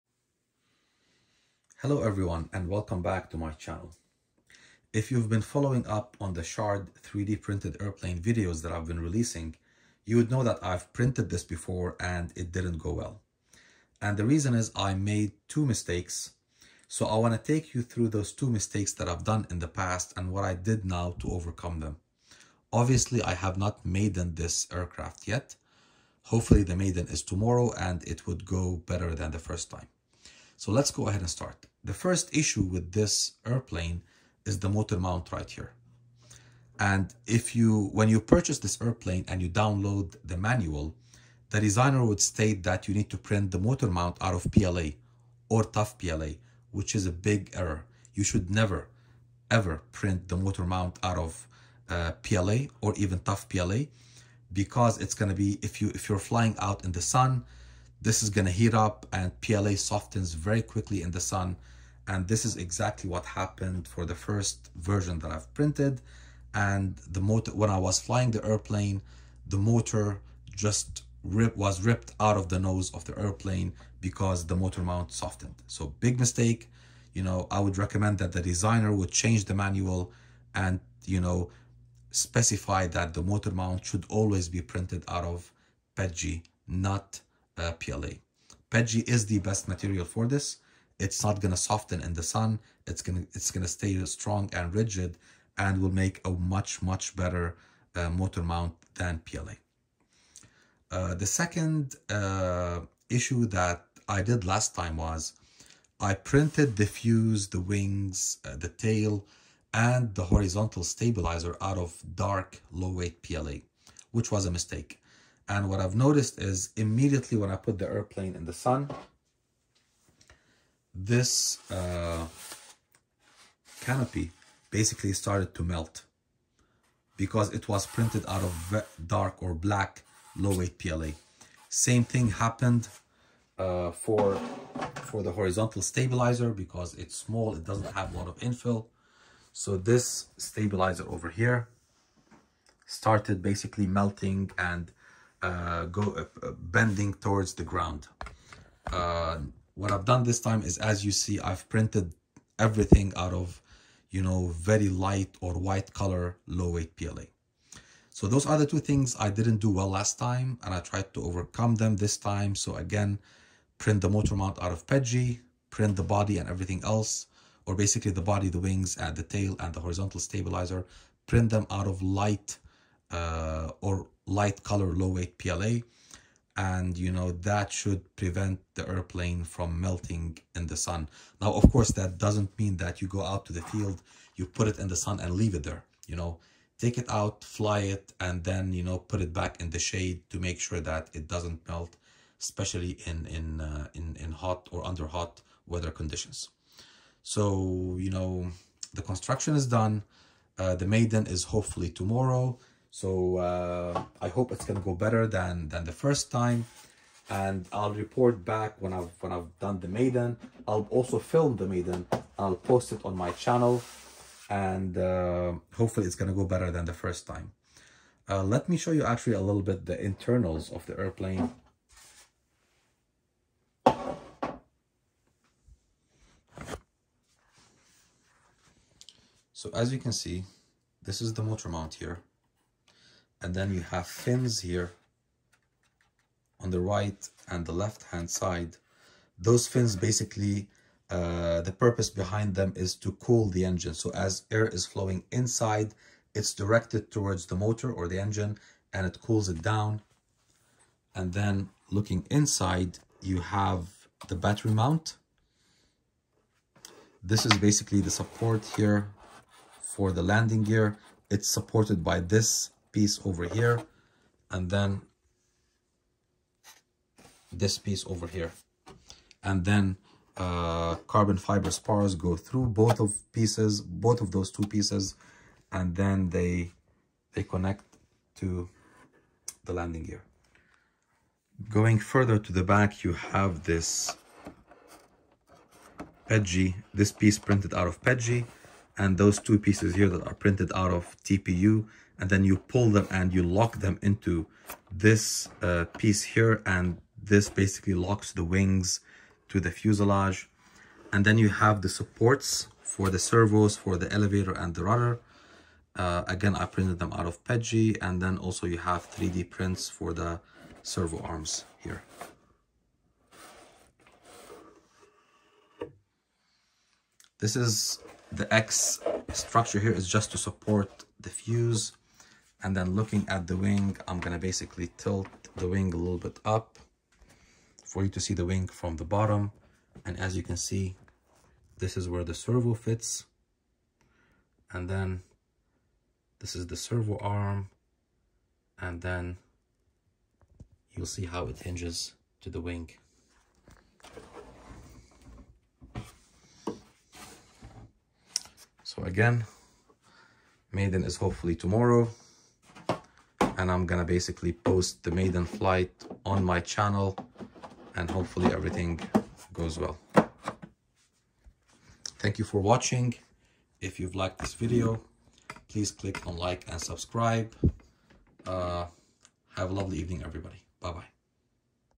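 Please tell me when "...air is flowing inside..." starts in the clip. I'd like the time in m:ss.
4:04.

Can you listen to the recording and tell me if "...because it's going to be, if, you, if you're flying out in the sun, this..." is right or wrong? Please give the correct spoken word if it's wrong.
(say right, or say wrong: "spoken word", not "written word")
right.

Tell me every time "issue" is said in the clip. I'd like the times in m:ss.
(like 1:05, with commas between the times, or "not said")
0:32, 1:43.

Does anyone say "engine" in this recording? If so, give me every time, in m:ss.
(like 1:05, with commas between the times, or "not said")
4:03, 4:08.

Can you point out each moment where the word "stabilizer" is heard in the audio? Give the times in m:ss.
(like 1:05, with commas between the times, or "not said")
1:50, 2:15, 2:20, 2:50.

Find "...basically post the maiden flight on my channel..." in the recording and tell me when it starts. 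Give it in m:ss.
5:54.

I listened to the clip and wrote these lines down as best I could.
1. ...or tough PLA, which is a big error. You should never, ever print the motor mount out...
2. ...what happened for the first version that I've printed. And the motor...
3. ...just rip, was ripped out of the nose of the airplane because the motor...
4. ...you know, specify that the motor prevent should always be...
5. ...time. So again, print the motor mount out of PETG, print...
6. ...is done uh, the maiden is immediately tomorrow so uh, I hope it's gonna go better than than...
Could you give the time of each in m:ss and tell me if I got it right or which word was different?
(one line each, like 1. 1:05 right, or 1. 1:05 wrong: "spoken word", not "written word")
1. 0:45 right
2. 1:03 right
3. 1:10 right
4. 1:21 wrong: "mount", not "prevent"
5. 2:42 right
6. 3:19 wrong: "hopefully", not "immediately".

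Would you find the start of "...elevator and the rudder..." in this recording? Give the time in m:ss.
5:04.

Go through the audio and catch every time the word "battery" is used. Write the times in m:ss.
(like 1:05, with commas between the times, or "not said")
4:14.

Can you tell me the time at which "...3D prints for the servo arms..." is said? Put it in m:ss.
5:09.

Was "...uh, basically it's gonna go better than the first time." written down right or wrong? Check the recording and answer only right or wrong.
wrong.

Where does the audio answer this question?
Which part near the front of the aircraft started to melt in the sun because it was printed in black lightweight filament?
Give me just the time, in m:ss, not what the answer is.
2:03.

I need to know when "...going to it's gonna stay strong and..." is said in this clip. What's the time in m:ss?
1:33.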